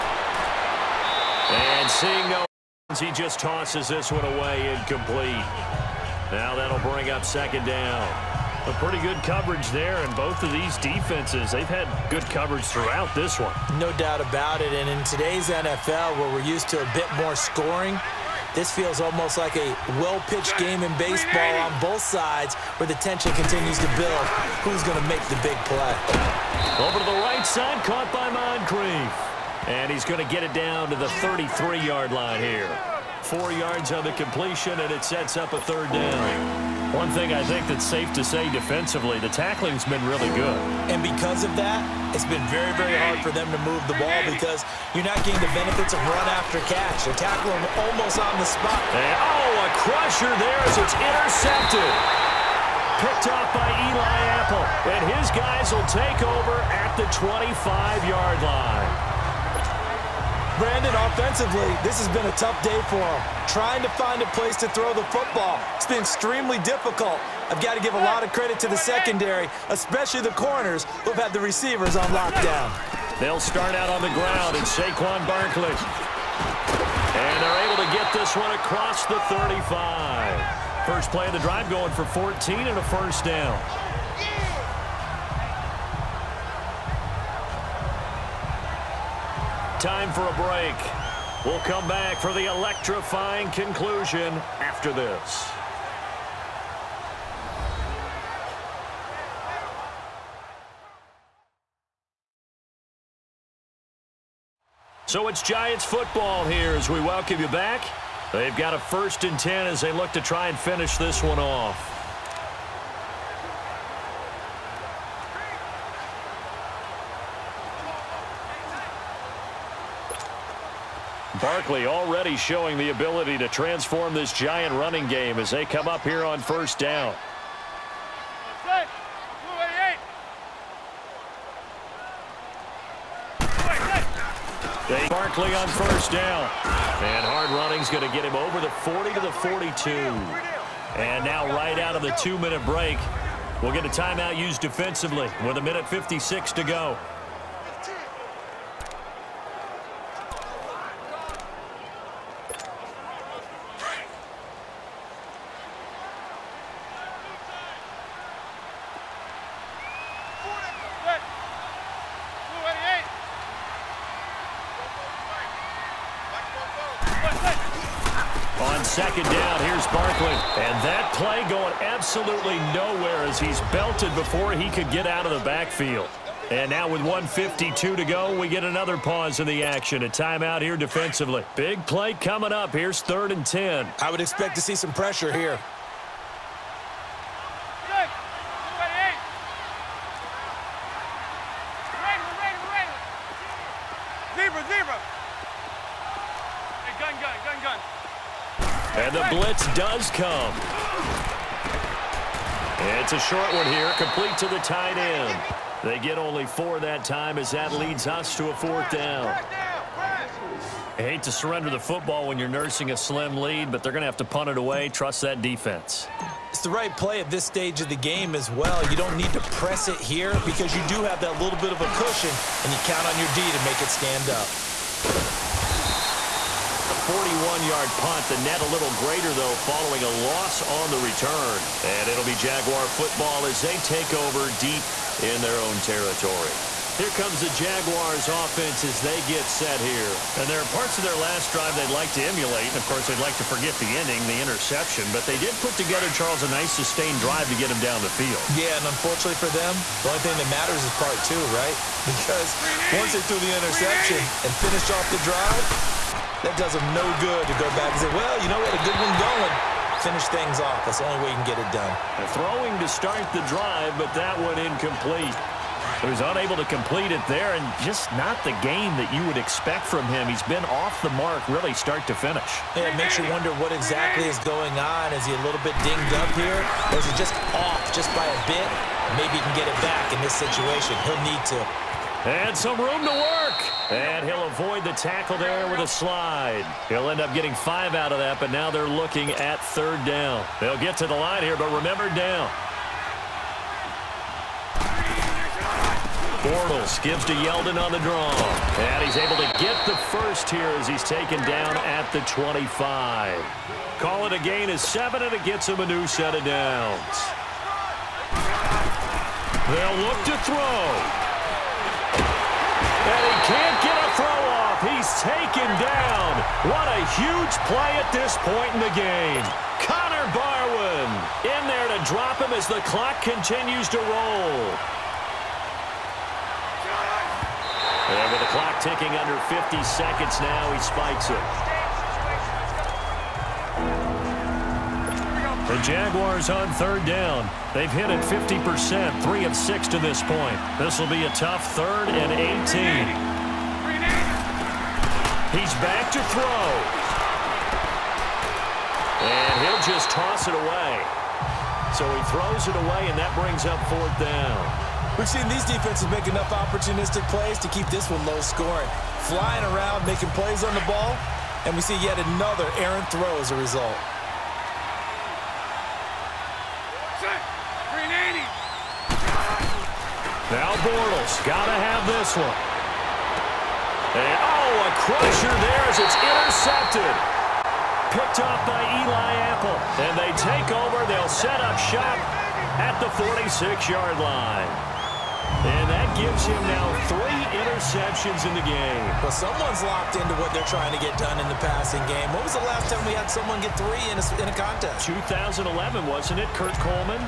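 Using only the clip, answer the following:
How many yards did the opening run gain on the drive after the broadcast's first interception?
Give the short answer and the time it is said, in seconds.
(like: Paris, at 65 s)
14, at 82 s.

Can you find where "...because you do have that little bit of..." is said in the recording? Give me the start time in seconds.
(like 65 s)
220 s.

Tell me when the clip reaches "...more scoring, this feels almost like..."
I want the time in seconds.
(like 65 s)
17 s.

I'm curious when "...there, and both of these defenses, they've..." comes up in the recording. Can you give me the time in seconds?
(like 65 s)
9 s.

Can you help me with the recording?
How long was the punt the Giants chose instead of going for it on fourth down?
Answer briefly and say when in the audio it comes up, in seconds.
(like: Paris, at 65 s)
41 yards, at 227 s.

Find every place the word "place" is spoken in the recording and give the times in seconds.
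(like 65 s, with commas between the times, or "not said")
64 s.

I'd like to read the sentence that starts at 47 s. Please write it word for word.
They tackle him almost on the spot.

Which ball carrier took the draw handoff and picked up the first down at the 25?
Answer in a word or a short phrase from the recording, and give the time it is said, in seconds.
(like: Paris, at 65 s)
Yeldon, at 297 s.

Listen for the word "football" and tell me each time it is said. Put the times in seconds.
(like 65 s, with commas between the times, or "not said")
65 s, 105 s, 211 s, 232 s.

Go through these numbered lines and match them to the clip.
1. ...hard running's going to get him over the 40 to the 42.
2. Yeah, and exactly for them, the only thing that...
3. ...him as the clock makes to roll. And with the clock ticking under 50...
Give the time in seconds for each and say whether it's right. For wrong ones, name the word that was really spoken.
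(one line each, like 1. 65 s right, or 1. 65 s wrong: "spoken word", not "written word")
1. 137 s right
2. 248 s wrong: "unfortunately", not "exactly"
3. 322 s wrong: "continues", not "makes".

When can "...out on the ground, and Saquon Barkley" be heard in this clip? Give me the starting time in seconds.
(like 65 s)
73 s.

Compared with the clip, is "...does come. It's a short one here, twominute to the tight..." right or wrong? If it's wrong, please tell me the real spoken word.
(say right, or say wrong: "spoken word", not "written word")
wrong: "complete", not "twominute".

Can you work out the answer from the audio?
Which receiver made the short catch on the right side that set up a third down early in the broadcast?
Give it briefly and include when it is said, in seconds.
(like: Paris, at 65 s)
Moncrief, at 28 s.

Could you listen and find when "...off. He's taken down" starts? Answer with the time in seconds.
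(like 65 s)
314 s.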